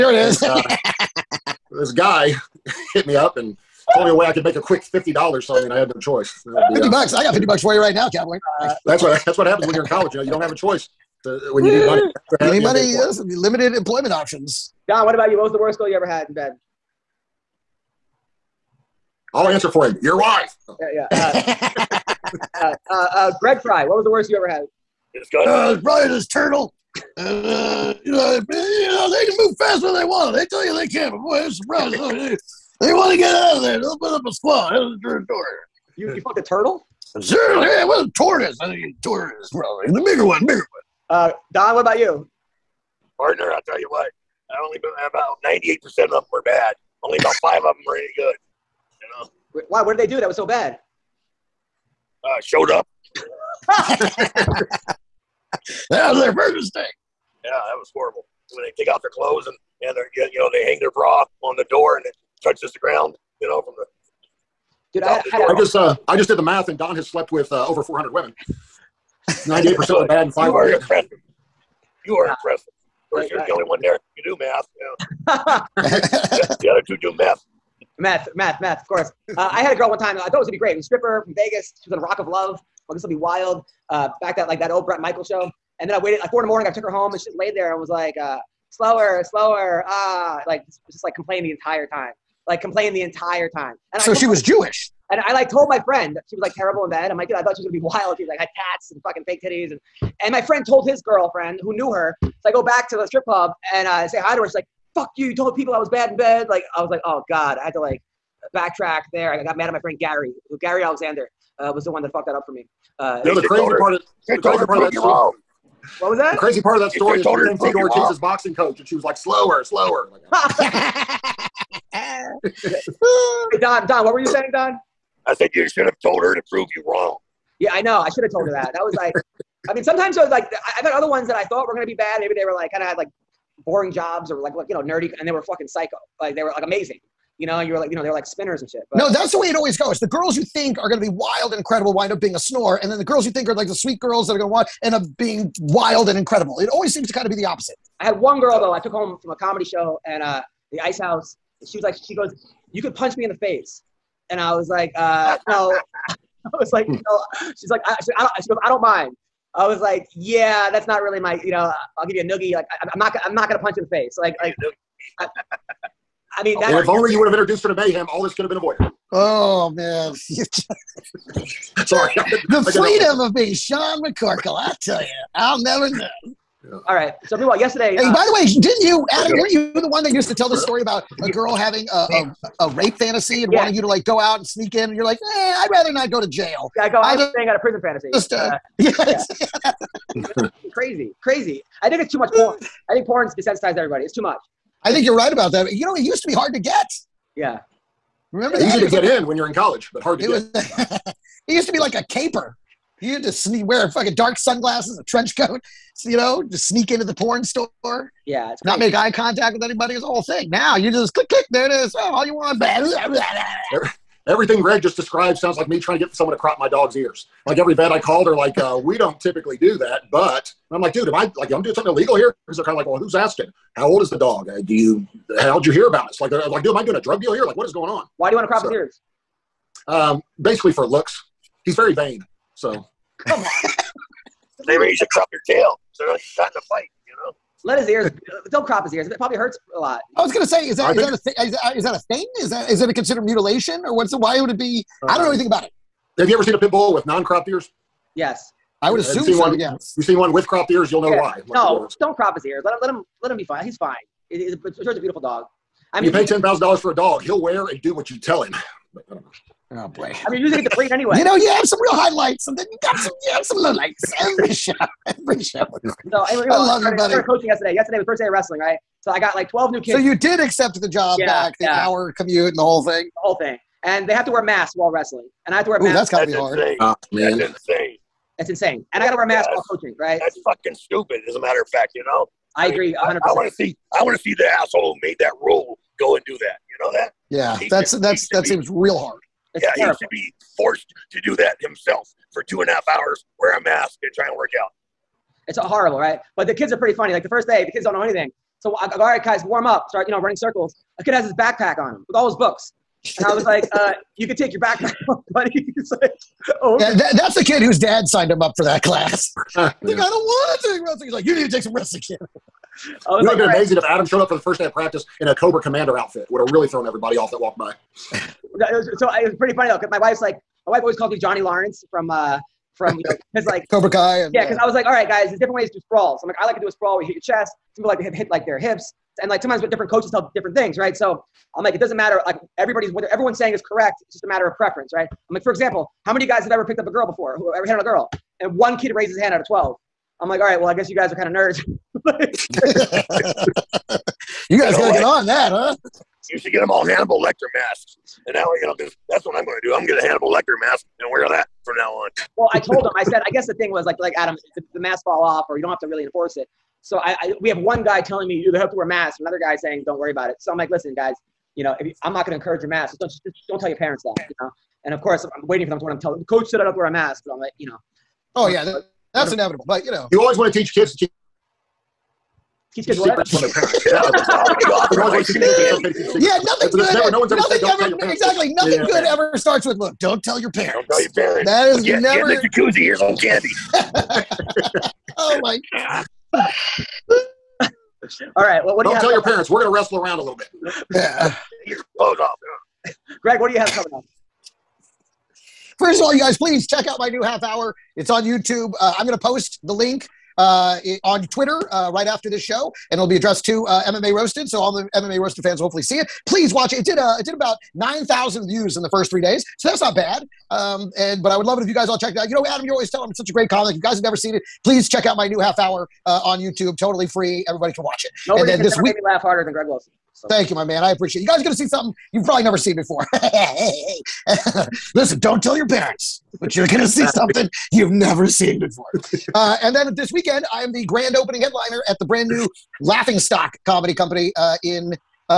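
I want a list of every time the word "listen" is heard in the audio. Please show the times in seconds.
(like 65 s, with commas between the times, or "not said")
360 s, 424 s.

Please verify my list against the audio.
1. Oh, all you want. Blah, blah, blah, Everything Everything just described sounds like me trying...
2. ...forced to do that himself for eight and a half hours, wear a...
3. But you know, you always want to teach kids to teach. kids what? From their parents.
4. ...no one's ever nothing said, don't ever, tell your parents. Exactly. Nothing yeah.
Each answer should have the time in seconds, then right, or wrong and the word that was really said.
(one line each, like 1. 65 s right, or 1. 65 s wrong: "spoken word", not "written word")
1. 211 s wrong: "Greg", not "Everything"
2. 290 s wrong: "two", not "eight"
3. 369 s right
4. 377 s right.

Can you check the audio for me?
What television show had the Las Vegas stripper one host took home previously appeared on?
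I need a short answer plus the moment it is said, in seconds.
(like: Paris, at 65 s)
Rock of Love, at 82 s.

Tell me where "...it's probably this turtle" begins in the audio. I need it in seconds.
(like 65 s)
25 s.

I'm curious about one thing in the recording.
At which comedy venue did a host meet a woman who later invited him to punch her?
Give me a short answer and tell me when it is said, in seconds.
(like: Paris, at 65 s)
The Ice House, at 150 s.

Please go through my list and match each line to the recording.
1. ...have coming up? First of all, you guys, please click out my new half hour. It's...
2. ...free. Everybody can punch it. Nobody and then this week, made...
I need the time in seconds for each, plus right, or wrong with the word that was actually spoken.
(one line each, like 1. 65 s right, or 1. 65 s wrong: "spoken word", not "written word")
1. 393 s wrong: "check", not "click"
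2. 417 s wrong: "watch", not "punch".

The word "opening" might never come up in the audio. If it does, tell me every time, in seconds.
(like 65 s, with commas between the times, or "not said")
431 s.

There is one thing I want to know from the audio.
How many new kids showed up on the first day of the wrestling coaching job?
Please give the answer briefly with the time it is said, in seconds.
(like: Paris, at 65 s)
12, at 269 s.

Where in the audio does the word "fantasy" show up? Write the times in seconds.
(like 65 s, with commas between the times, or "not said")
182 s, 187 s.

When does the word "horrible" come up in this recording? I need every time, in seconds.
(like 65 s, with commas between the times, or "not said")
57 s, 295 s.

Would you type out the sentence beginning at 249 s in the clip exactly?
You've seen one with cropped ears, you'll know yeah.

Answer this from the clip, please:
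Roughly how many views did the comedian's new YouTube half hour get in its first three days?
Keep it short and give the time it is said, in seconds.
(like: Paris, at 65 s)
9,000, at 407 s.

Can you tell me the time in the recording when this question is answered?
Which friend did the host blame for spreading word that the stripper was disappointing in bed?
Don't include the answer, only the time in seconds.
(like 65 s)
110 s.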